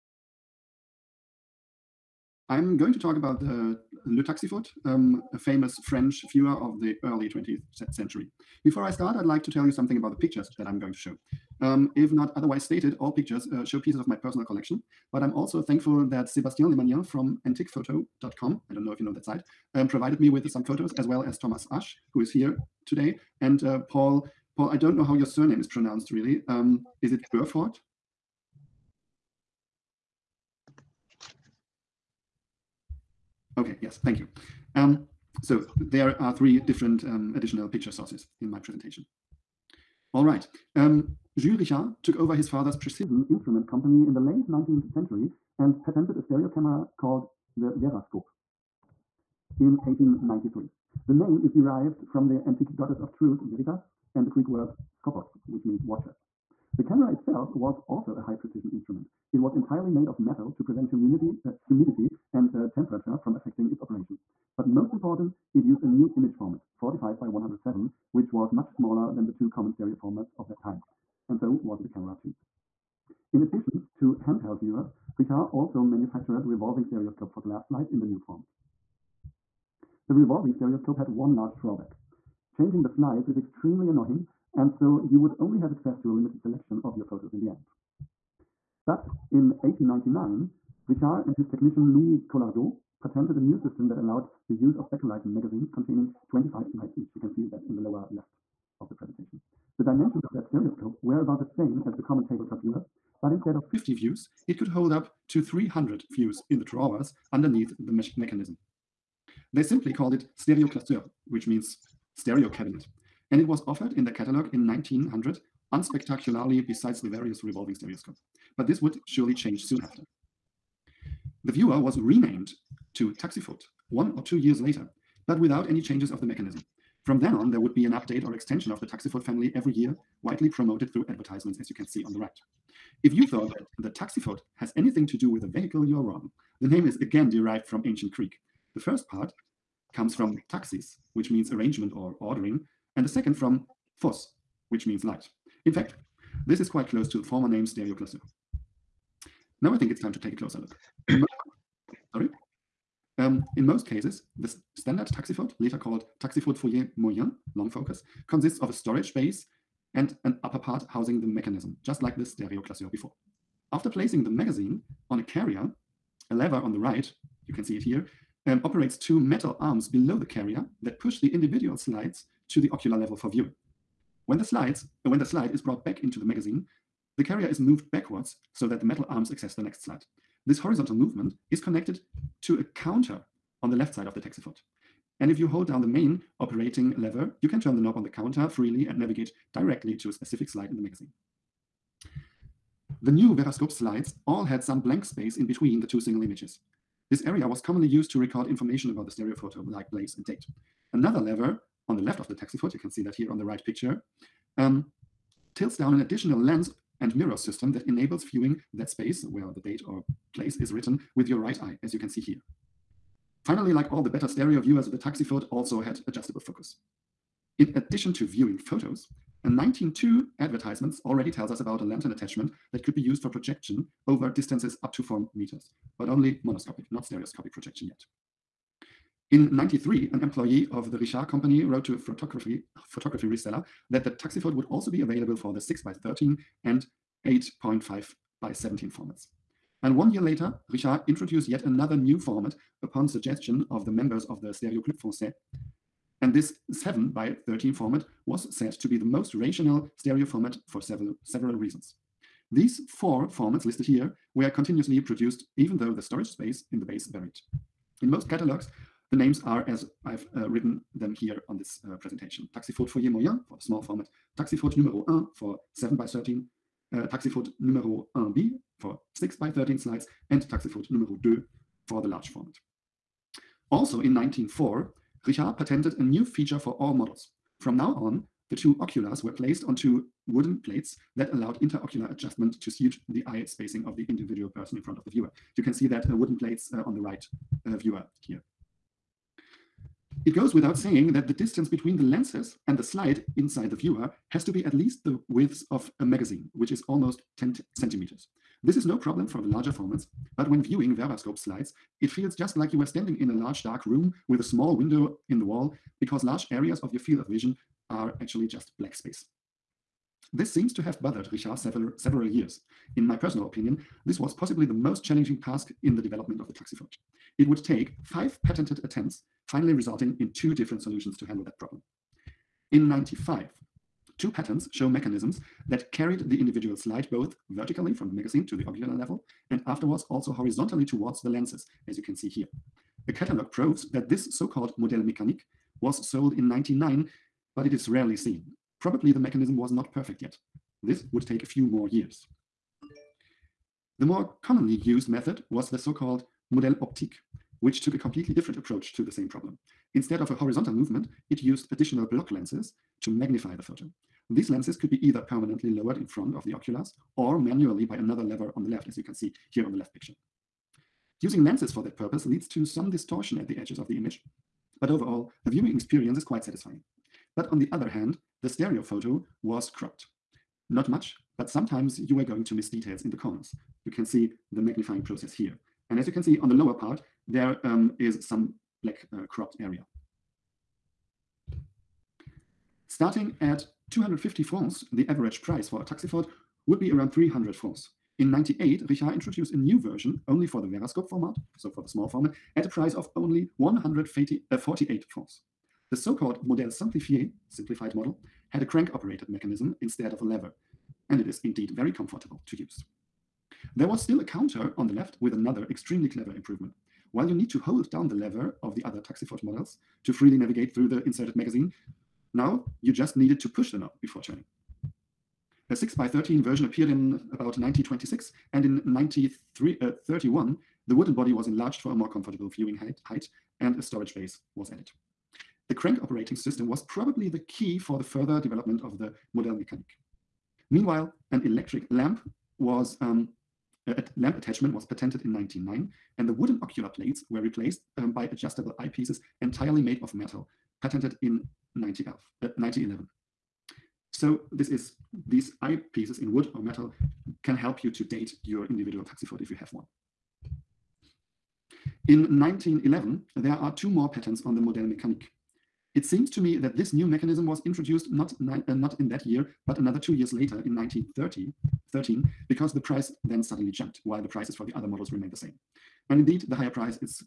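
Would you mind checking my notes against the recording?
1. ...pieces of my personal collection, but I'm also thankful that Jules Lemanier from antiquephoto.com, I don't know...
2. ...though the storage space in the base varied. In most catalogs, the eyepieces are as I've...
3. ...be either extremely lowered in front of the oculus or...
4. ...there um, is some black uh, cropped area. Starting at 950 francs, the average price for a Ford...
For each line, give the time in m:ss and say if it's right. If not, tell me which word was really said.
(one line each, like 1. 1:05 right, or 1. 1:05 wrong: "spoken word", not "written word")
1. 0:13 wrong: "Sébastien", not "Jules"
2. 4:15 wrong: "names", not "eyepieces"
3. 5:54 wrong: "permanently", not "extremely"
4. 6:17 wrong: "250", not "950".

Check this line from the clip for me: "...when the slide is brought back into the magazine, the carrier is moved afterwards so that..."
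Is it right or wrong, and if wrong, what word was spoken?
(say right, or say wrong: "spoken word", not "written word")
wrong: "backwards", not "afterwards".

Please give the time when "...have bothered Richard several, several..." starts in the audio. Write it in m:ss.
5:10.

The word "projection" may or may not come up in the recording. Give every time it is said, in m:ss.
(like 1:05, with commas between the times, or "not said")
3:43, 3:47.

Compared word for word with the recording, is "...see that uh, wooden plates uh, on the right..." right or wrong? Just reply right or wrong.
right.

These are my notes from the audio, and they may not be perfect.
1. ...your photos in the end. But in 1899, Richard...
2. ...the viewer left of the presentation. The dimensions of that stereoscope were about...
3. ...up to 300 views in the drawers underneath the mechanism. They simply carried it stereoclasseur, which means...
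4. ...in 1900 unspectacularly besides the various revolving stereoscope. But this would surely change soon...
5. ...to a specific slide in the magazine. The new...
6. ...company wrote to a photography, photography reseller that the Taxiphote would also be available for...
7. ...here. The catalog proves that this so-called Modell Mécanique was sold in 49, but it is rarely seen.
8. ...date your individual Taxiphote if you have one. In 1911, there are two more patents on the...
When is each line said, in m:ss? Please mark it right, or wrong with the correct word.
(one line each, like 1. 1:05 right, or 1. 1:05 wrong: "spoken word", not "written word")
1. 1:26 right
2. 1:37 wrong: "lower", not "viewer"
3. 1:44 wrong: "called", not "carried"
4. 1:54 right
5. 3:09 right
6. 3:51 right
7. 5:32 wrong: "99", not "49"
8. 7:28 right.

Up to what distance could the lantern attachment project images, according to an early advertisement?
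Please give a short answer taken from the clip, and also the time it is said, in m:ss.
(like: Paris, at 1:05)
4 meters, at 3:45.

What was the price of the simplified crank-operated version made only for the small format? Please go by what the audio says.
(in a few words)
148 francs.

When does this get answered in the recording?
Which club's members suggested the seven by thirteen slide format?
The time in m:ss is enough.
4:04.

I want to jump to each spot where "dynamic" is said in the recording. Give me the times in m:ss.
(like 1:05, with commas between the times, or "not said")
not said.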